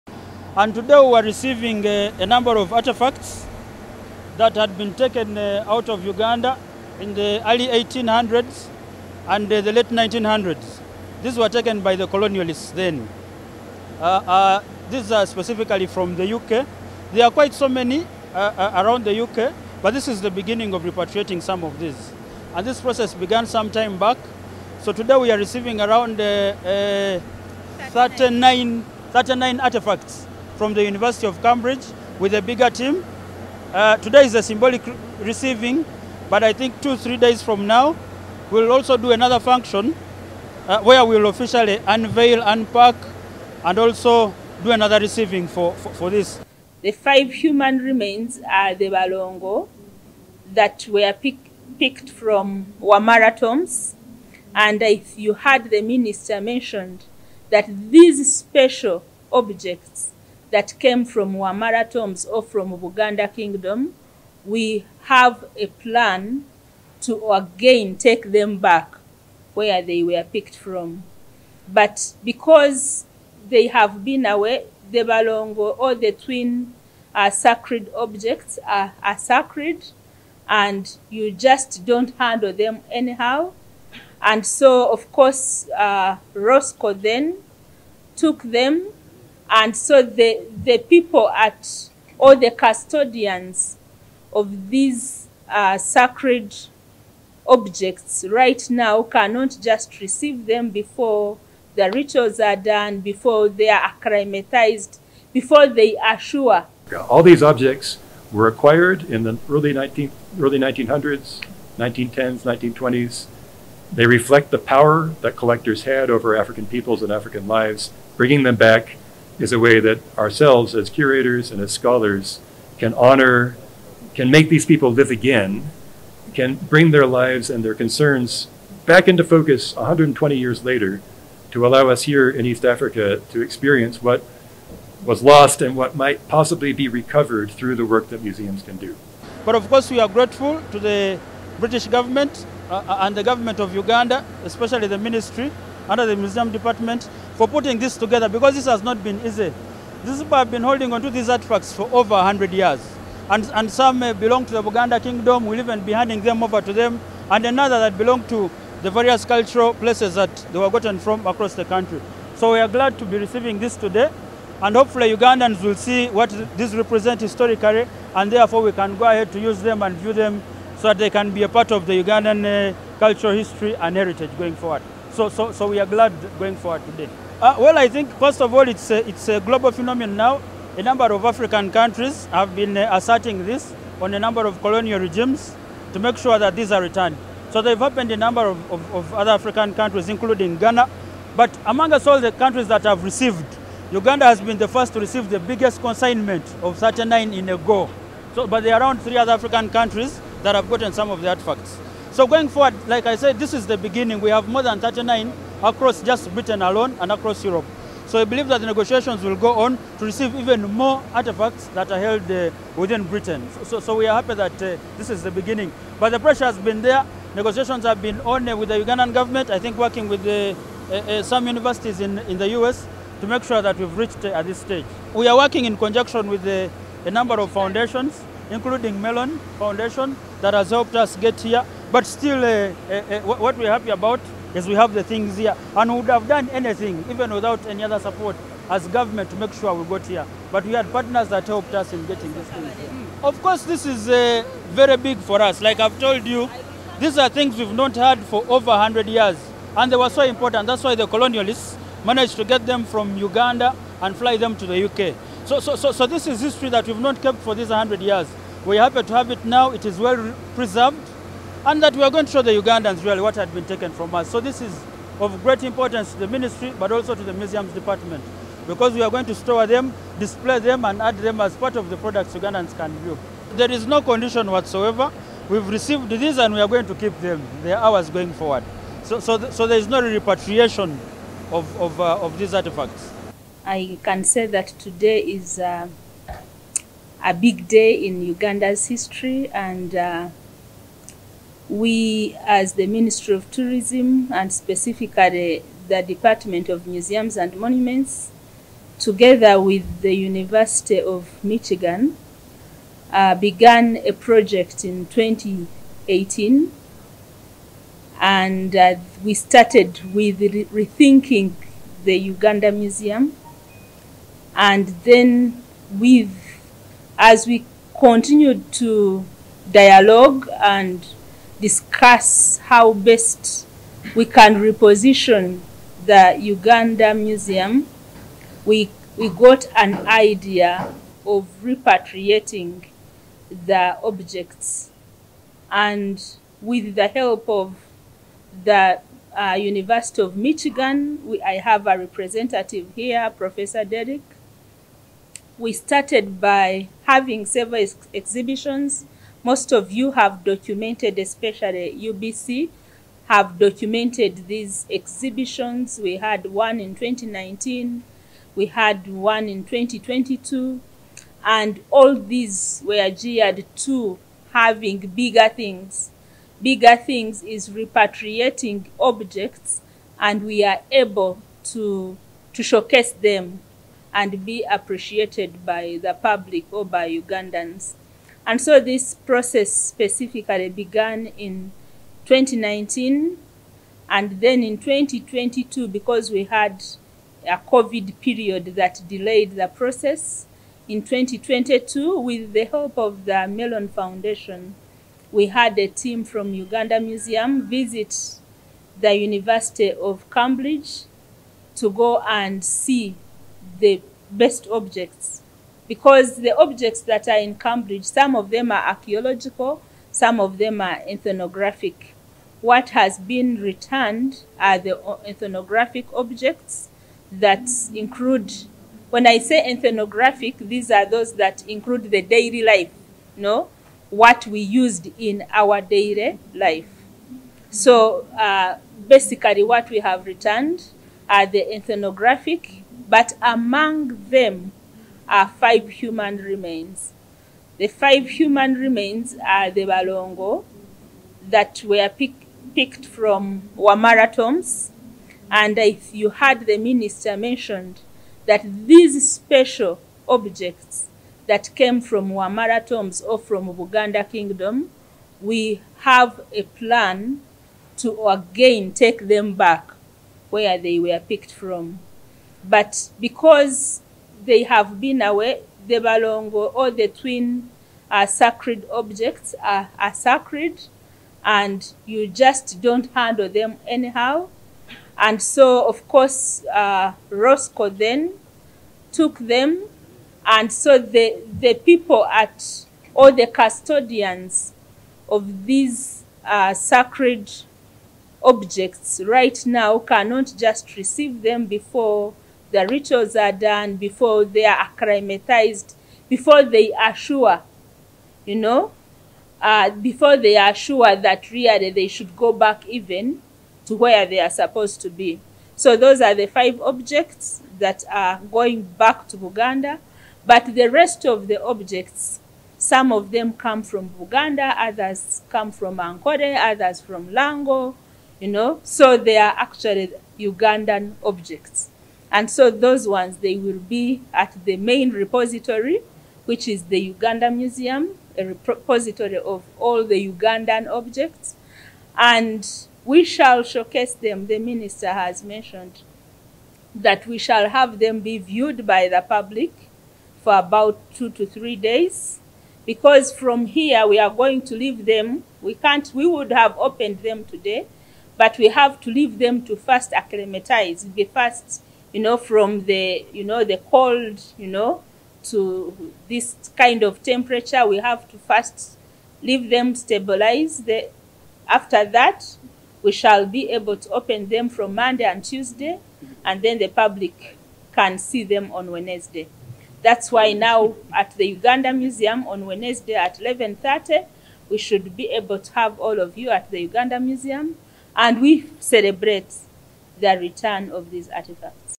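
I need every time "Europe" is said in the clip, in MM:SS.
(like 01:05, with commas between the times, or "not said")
03:27.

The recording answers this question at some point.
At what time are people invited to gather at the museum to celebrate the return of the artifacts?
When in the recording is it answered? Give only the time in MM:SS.
09:33.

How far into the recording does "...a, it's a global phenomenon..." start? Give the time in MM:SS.
02:58.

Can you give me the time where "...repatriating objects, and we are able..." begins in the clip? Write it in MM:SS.
06:07.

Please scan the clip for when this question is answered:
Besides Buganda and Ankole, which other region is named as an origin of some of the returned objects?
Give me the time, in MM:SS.
08:37.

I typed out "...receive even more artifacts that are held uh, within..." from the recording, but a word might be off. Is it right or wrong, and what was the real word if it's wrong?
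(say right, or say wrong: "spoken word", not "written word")
right.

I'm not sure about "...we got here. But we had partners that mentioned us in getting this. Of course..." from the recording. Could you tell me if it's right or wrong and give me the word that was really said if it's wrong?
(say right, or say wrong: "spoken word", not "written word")
wrong: "helped", not "mentioned".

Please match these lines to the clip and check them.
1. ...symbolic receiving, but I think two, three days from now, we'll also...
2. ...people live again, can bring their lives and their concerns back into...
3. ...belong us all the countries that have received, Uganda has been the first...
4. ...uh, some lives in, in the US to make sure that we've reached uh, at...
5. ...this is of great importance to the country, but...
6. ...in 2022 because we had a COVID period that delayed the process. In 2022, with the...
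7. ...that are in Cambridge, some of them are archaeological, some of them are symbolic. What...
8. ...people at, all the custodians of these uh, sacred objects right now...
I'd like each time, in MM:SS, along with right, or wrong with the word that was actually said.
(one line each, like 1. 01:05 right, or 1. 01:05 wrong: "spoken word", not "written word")
1. 00:34 right
2. 02:04 right
3. 03:11 wrong: "among", not "belong"
4. 03:40 wrong: "universities", not "lives"
5. 04:24 wrong: "ministry", not "country"
6. 06:24 right
7. 06:47 wrong: "ethnographic", not "symbolic"
8. 08:01 right.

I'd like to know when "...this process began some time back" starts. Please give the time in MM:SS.
00:22.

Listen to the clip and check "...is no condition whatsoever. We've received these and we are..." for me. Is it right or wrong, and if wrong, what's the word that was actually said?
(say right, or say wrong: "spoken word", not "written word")
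right.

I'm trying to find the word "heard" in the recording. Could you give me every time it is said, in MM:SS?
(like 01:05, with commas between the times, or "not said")
00:55, 07:26.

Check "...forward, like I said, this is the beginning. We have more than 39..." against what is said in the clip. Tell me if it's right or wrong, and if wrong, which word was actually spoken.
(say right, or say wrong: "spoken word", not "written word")
right.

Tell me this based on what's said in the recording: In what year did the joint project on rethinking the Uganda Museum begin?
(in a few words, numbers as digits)
2018.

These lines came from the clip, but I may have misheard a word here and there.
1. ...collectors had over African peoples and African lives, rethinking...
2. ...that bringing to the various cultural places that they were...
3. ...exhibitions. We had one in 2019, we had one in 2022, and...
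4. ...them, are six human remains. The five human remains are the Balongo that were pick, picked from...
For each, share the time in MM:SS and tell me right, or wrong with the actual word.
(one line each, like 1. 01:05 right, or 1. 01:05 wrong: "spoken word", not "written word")
1. 01:55 wrong: "bringing", not "rethinking"
2. 02:37 wrong: "belong", not "bringing"
3. 05:54 right
4. 07:14 wrong: "five", not "six".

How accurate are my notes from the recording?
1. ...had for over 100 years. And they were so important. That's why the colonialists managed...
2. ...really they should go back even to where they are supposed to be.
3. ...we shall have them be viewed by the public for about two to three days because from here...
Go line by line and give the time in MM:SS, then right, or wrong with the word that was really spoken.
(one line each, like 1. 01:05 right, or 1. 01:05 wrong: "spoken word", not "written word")
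1. 04:07 right
2. 08:21 right
3. 08:57 right.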